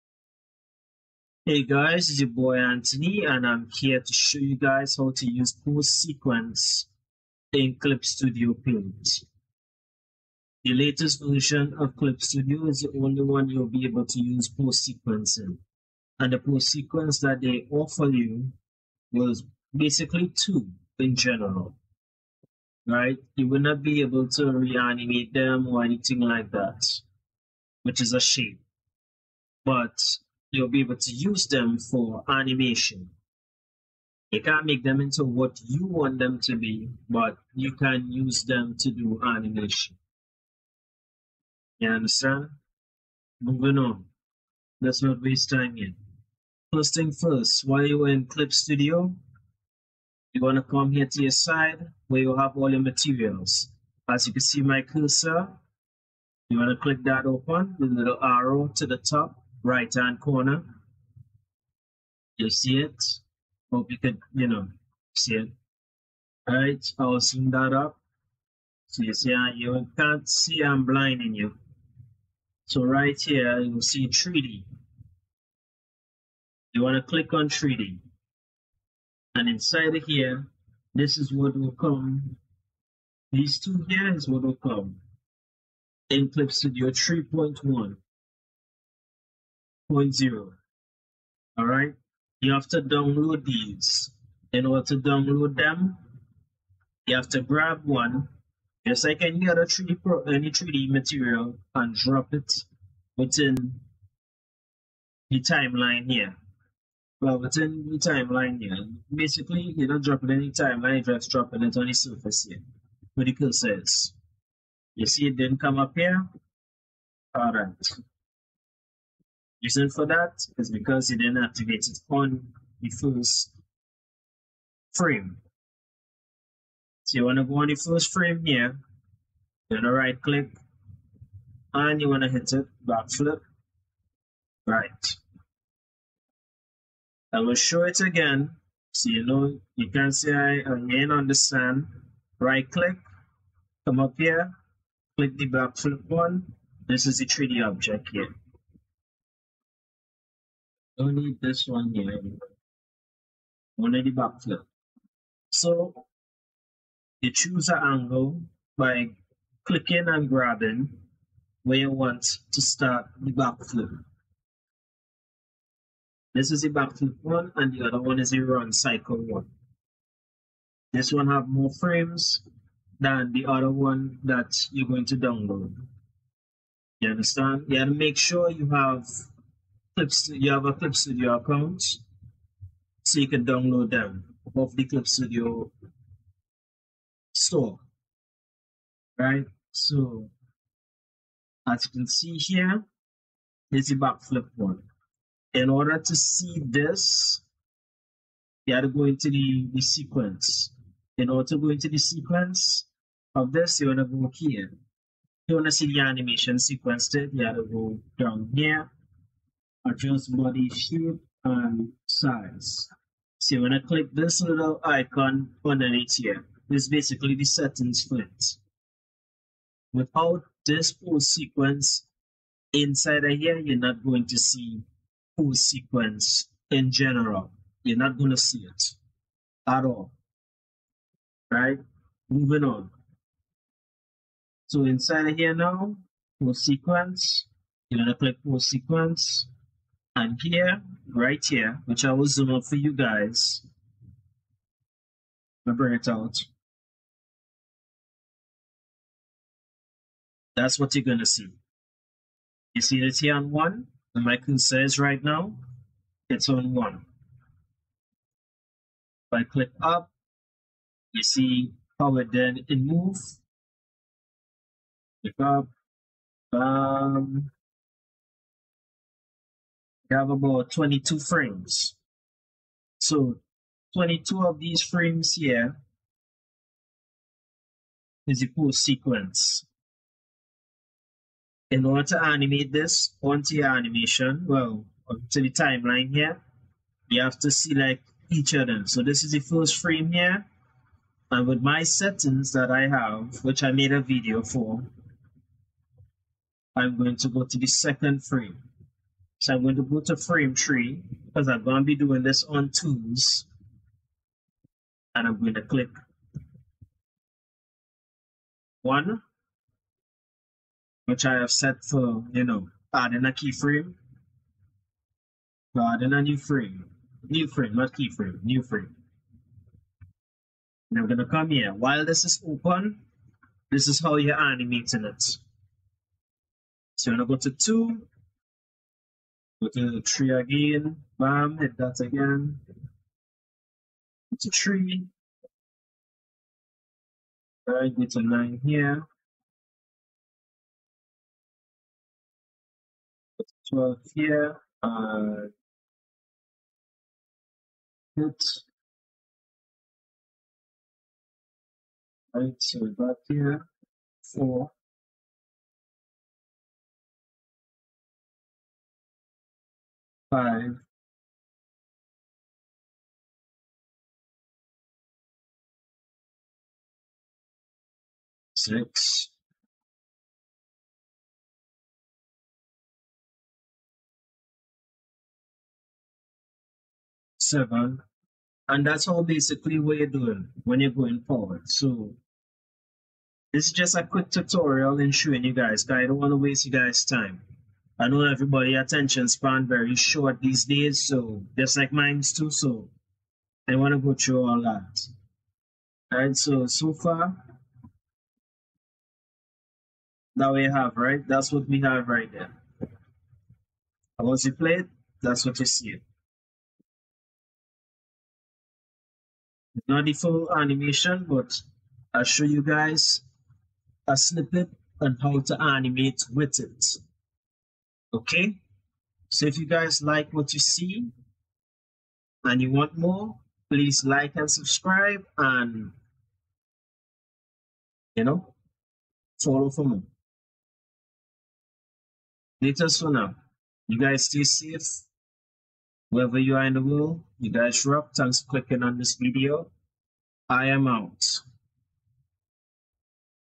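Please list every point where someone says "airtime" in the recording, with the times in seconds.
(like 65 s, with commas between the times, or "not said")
not said.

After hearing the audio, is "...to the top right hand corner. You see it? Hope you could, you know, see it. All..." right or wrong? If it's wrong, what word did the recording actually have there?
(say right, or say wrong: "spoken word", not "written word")
right.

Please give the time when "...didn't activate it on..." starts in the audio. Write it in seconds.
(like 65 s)
121 s.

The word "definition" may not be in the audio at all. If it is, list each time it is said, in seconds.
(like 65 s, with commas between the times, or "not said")
not said.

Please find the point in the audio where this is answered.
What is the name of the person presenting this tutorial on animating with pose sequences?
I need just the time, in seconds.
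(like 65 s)
2 s.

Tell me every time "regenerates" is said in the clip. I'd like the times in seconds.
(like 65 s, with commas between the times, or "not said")
not said.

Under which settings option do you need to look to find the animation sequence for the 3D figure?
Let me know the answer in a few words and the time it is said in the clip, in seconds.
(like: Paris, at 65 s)
Adjust body shape and size, at 209 s.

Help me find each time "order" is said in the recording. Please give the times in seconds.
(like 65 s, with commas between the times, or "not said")
94 s, 195 s, 201 s, 281 s.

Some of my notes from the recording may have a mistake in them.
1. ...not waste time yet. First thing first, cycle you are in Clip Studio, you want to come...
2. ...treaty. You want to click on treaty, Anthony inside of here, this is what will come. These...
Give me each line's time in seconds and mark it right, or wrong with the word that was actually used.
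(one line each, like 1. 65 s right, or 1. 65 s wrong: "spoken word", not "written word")
1. 45 s wrong: "while", not "cycle"
2. 74 s wrong: "And", not "Anthony".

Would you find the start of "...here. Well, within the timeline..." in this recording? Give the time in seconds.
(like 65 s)
106 s.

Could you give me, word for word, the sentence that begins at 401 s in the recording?
That's what we have right there.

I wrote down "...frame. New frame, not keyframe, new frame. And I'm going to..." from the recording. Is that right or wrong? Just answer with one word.
right.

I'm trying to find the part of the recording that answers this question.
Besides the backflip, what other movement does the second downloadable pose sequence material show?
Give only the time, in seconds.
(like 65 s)
168 s.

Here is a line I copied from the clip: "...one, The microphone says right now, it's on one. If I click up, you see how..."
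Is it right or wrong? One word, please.
right.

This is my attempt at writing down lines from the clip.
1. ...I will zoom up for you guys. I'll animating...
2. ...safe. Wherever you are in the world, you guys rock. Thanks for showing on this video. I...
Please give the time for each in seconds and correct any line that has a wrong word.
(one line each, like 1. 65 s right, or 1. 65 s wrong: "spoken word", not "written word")
1. 242 s wrong: "bring", not "animating"
2. 434 s wrong: "clicking", not "showing".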